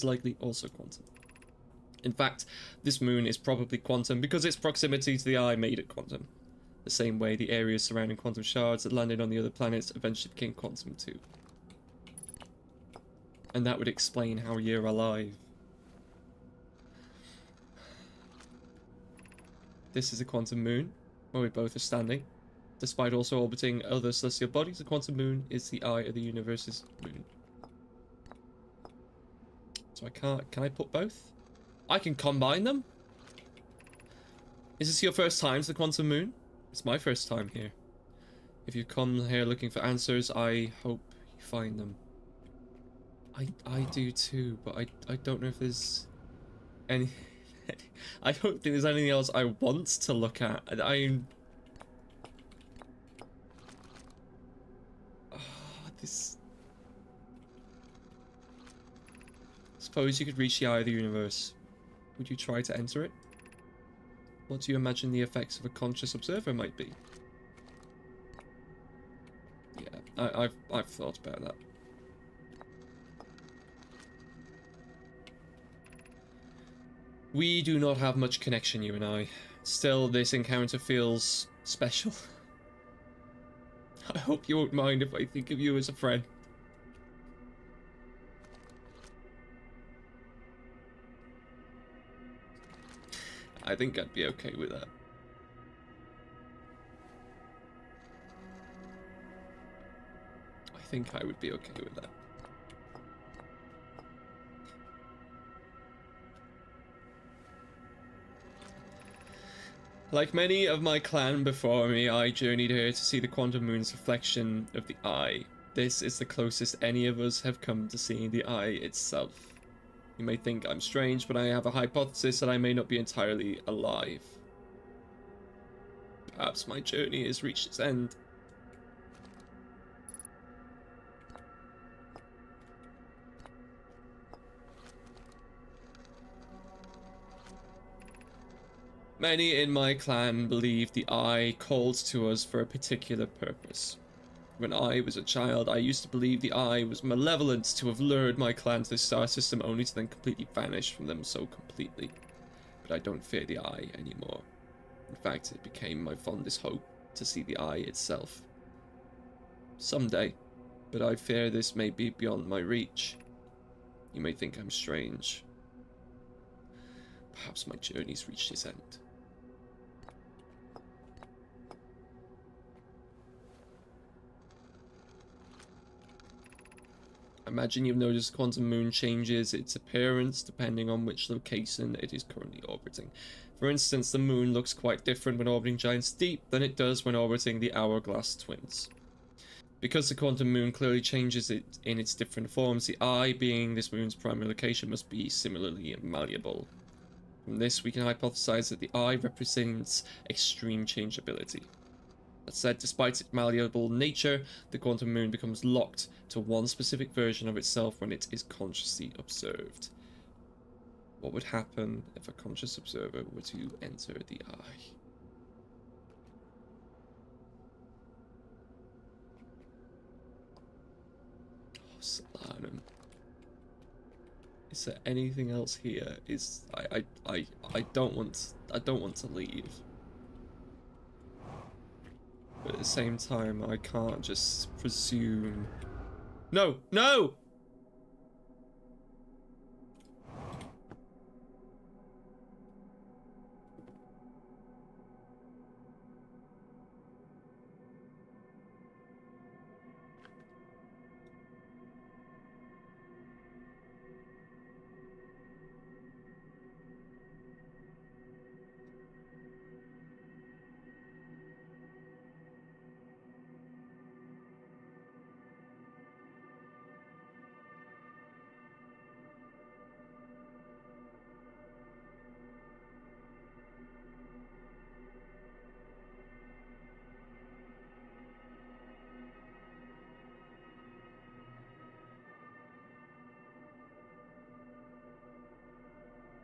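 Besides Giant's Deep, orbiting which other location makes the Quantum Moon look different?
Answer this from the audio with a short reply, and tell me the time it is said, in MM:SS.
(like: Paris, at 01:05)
Hourglass Twins, at 03:07.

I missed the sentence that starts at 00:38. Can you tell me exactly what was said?
If you come here looking for answers, I hope you find them.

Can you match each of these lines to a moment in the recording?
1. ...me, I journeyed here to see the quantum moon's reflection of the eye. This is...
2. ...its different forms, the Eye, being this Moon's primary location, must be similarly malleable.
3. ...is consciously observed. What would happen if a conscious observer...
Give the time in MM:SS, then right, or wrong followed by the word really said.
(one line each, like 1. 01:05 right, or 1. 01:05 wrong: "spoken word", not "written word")
1. 01:51 right
2. 03:11 right
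3. 03:28 right.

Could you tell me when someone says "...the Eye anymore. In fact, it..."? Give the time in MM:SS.
02:33.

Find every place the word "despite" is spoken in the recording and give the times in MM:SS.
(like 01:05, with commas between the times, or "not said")
00:22, 03:22.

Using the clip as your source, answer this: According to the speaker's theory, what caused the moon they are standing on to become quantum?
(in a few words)
Its proximity to the eye.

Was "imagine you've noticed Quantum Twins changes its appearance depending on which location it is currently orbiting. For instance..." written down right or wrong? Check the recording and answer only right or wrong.
wrong.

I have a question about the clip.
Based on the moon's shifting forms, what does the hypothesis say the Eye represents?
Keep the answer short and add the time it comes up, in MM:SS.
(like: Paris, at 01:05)
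Extreme changeability, at 03:20.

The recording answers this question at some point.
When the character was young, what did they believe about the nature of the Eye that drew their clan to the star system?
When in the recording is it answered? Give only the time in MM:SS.
02:27.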